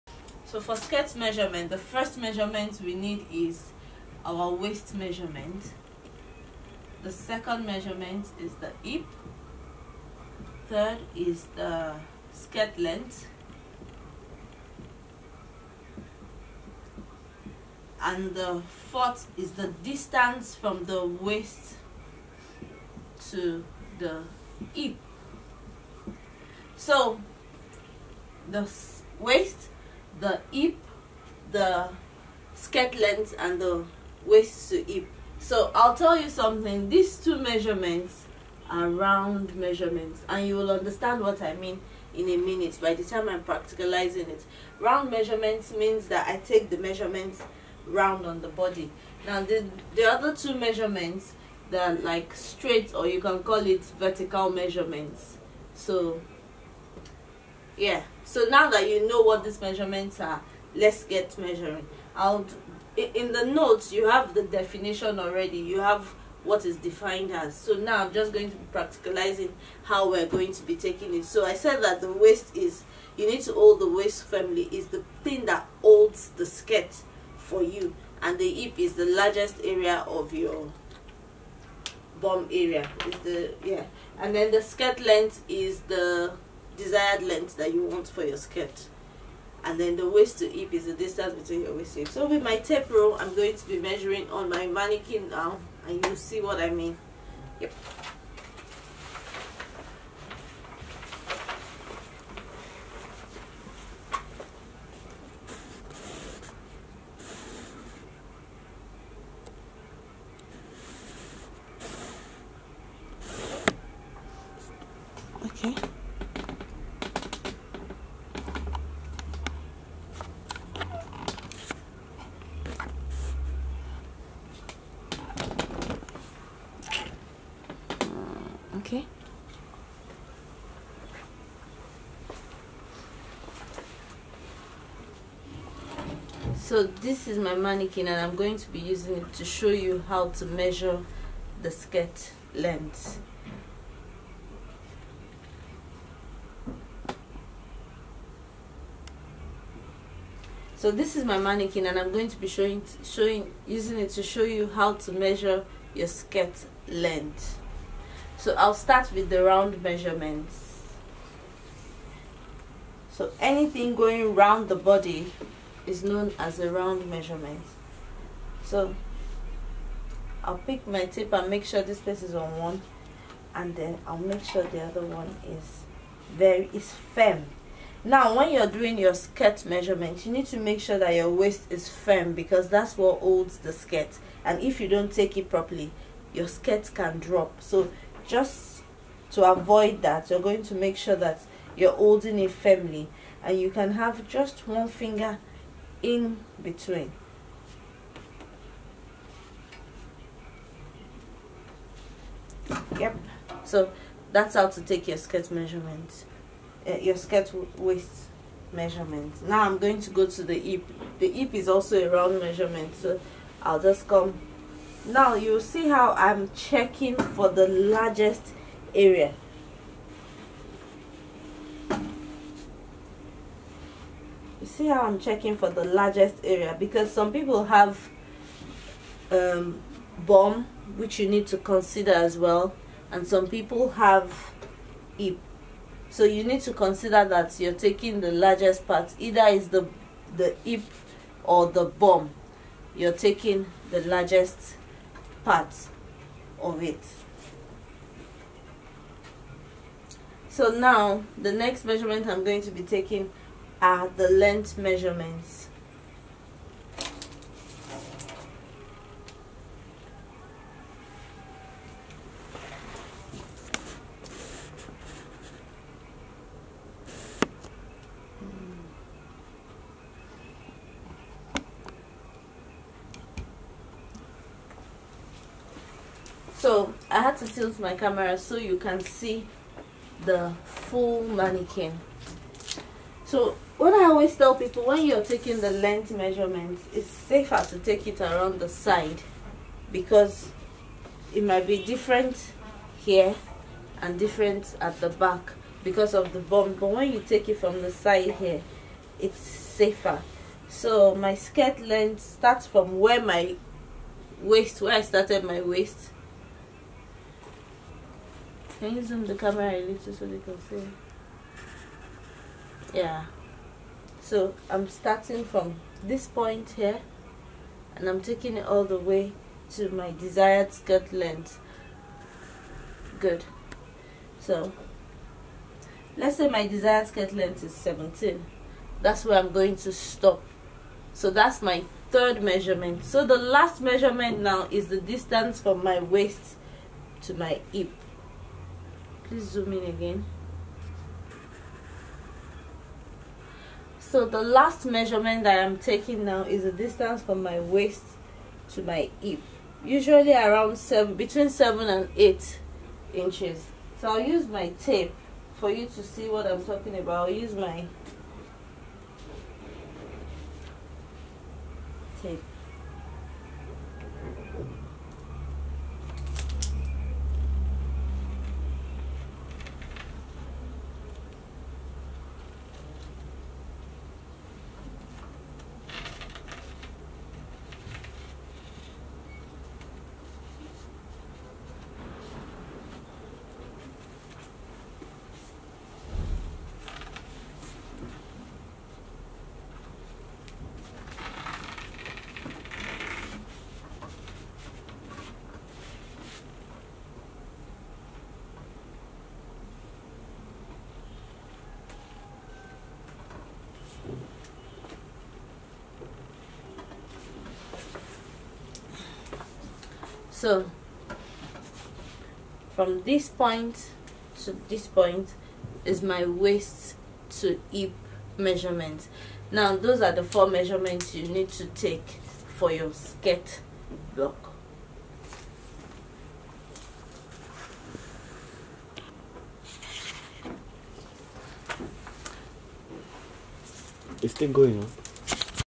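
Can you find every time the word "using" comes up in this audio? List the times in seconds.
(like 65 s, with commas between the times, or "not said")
138 s, 153 s.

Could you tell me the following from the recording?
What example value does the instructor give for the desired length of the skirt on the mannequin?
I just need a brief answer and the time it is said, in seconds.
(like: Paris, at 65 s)
17, at 327 s.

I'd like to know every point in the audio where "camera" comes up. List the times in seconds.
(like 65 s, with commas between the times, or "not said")
277 s, 309 s.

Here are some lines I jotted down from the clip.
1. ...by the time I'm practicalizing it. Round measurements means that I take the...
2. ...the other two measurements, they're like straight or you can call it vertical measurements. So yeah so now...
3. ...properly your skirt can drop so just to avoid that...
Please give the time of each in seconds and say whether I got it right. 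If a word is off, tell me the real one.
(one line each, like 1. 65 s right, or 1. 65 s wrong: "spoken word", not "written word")
1. 42 s right
2. 49 s right
3. 185 s right.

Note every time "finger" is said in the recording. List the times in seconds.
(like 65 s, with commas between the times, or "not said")
194 s.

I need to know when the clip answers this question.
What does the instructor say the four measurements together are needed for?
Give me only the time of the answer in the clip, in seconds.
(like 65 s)
422 s.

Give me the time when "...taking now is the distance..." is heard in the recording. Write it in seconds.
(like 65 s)
345 s.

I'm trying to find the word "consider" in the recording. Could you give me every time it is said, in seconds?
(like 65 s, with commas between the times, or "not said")
231 s, 236 s.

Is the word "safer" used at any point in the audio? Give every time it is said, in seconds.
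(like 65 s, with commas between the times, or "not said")
287 s, 299 s.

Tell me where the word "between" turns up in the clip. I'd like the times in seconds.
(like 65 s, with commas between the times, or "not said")
91 s, 196 s, 351 s.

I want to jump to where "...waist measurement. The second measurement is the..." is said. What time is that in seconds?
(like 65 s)
4 s.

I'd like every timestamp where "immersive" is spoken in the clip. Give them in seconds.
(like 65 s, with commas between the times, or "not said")
not said.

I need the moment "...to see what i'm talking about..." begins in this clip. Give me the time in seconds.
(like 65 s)
355 s.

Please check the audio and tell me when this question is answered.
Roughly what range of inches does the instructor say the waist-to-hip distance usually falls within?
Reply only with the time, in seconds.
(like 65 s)
351 s.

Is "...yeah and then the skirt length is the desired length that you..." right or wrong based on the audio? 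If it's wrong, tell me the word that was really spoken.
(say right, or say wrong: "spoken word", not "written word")
right.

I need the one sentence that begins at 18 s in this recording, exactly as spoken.
And the fourth is the distance from the waist to the hip.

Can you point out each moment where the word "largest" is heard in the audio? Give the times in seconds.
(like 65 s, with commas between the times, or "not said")
79 s, 217 s, 225 s, 238 s, 244 s.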